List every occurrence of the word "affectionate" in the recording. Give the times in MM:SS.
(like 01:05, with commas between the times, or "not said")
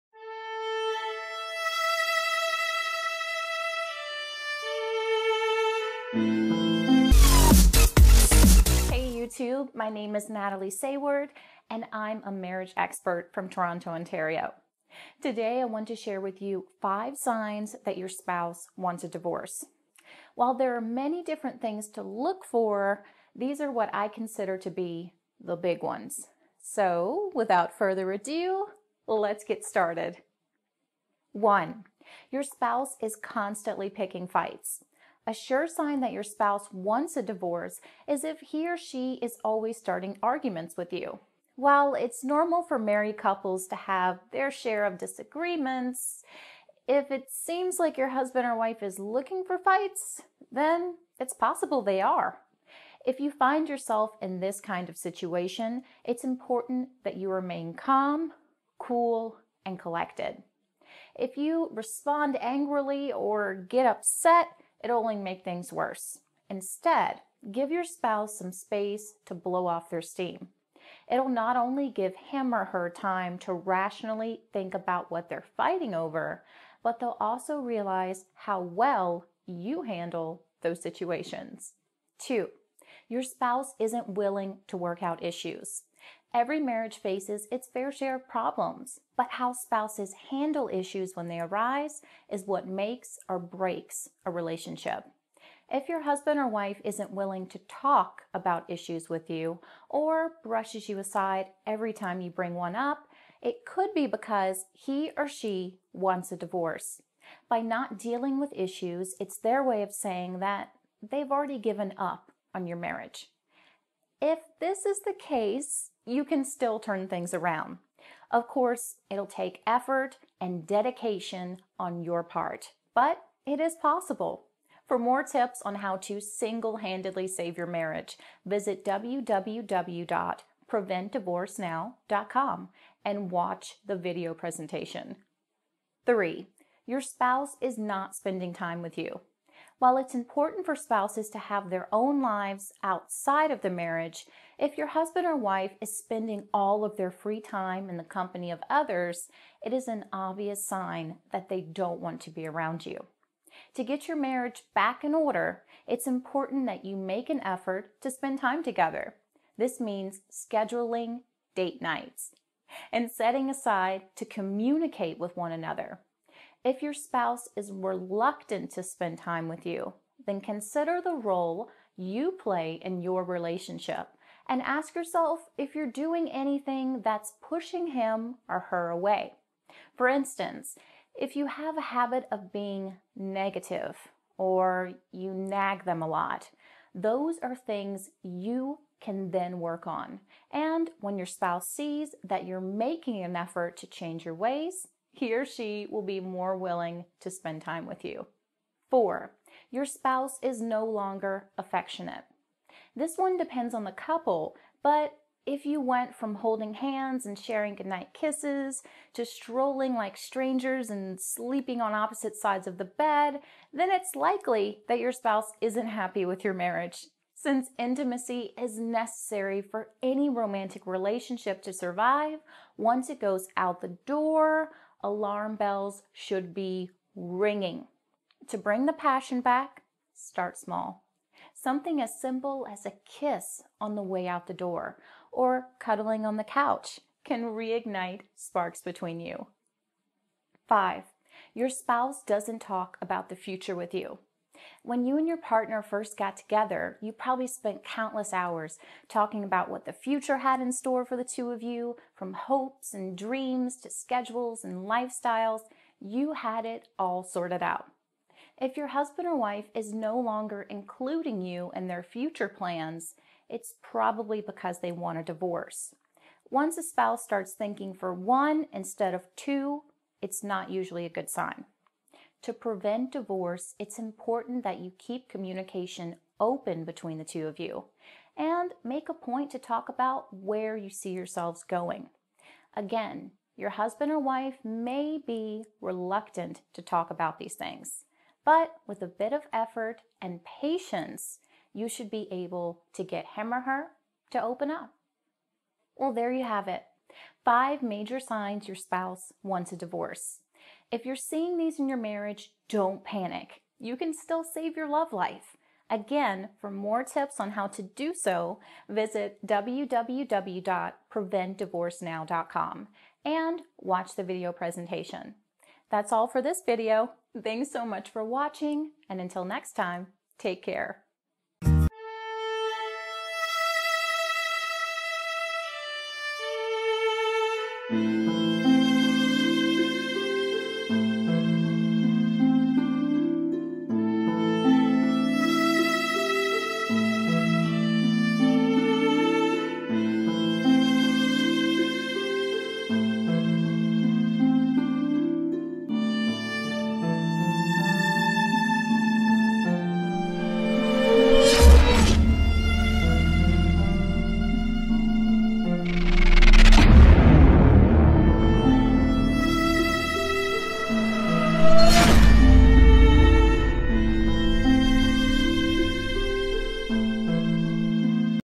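03:21.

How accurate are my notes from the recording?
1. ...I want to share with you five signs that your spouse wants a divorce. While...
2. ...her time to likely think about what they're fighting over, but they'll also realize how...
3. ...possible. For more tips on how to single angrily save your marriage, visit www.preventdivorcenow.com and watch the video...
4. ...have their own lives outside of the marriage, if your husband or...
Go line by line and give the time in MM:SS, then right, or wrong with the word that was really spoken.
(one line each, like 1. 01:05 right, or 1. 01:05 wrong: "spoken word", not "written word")
1. 00:15 right
2. 01:12 wrong: "rationally", not "likely"
3. 02:03 wrong: "handedly", not "angrily"
4. 02:21 right.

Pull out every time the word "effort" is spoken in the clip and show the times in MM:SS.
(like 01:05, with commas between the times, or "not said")
01:59, 02:37, 03:13, 04:49.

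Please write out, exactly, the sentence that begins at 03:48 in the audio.
To bring the passion back, start small.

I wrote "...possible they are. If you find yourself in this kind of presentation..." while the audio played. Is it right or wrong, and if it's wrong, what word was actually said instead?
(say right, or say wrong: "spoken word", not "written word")
wrong: "situation", not "presentation".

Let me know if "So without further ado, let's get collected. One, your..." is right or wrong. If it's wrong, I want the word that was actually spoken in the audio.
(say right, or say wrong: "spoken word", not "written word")
wrong: "started", not "collected".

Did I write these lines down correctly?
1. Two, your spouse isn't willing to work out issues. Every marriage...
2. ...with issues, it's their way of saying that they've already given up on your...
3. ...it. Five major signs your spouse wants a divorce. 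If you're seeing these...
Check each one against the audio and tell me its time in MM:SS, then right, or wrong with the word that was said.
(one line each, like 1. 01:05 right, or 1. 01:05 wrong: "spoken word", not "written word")
1. 01:22 right
2. 01:48 right
3. 04:56 right.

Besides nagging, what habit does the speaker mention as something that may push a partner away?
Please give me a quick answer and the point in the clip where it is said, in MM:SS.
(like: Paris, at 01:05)
Being negative, at 03:02.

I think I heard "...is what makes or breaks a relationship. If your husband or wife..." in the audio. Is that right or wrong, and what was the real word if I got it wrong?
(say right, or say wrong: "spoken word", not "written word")
right.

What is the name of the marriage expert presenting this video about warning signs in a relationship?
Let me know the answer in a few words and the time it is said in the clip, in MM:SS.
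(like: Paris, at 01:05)
Natalie Sayward, at 00:10.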